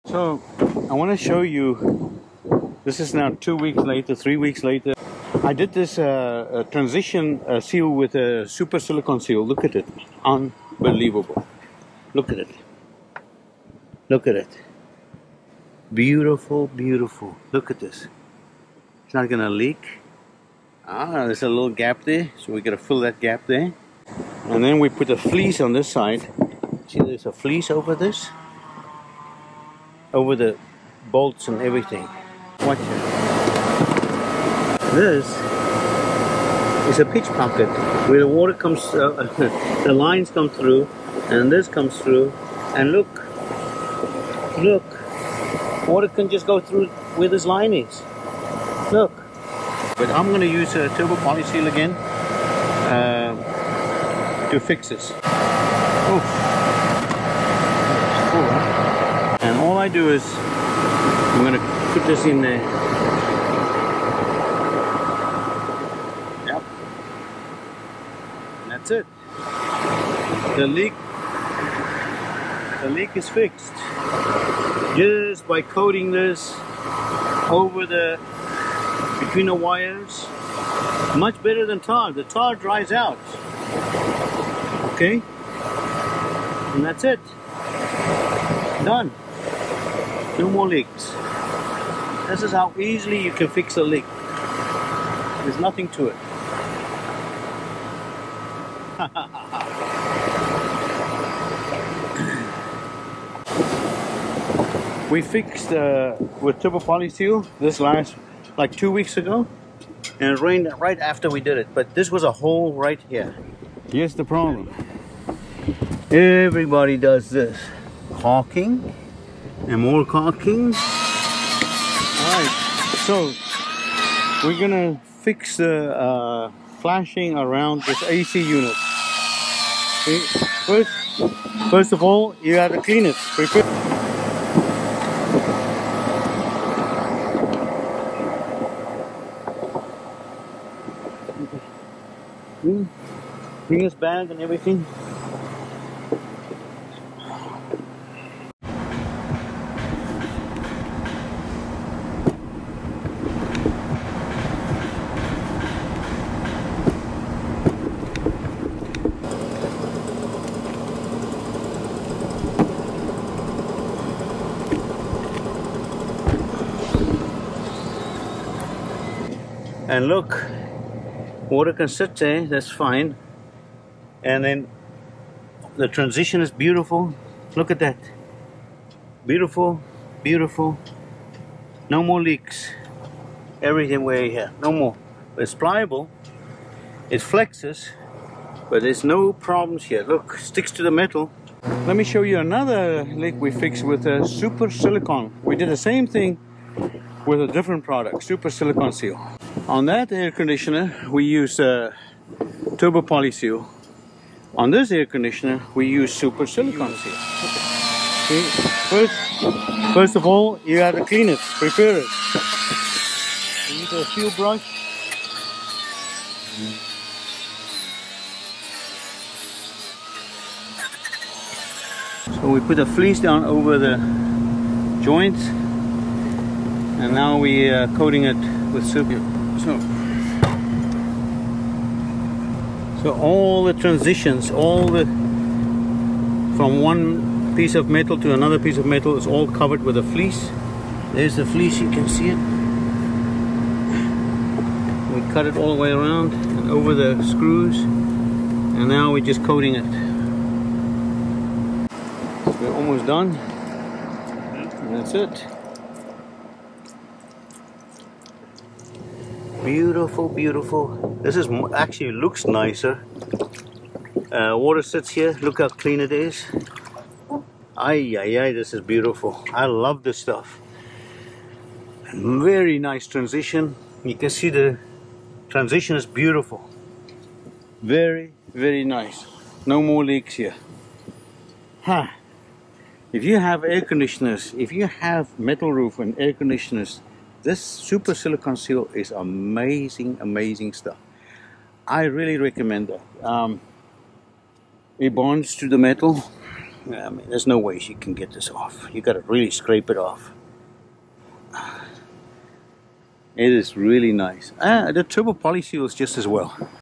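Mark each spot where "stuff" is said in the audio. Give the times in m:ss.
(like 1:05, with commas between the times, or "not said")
4:30, 4:50.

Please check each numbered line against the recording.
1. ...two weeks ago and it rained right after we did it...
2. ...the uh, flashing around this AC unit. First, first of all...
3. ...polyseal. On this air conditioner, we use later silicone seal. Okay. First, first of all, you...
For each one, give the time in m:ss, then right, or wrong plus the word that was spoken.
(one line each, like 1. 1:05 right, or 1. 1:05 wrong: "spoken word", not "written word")
1. 1:48 right
2. 2:05 right
3. 3:23 wrong: "super", not "later".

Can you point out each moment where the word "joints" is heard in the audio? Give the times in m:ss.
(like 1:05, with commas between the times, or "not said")
3:45.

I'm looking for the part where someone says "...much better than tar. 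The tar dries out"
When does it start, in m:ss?
1:21.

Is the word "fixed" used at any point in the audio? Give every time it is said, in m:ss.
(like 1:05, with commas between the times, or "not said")
1:13, 1:45, 3:13.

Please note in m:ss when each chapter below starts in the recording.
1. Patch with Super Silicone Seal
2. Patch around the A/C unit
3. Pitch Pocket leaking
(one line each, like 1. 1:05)
1. 3:30
2. 1:51
3. 0:35.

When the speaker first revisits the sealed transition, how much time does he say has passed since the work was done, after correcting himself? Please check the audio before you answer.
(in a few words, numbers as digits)
three weeks.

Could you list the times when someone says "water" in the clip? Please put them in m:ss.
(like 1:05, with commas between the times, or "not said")
0:38, 0:45, 2:51, 4:24.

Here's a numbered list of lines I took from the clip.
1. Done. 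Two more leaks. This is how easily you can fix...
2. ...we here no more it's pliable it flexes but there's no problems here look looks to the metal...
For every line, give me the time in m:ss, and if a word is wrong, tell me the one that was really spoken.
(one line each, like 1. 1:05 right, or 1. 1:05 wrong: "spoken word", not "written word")
1. 1:28 right
2. 3:04 wrong: "sticks", not "looks".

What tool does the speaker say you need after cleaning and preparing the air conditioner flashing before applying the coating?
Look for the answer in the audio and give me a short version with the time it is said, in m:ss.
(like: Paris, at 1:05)
a seal brush, at 3:34.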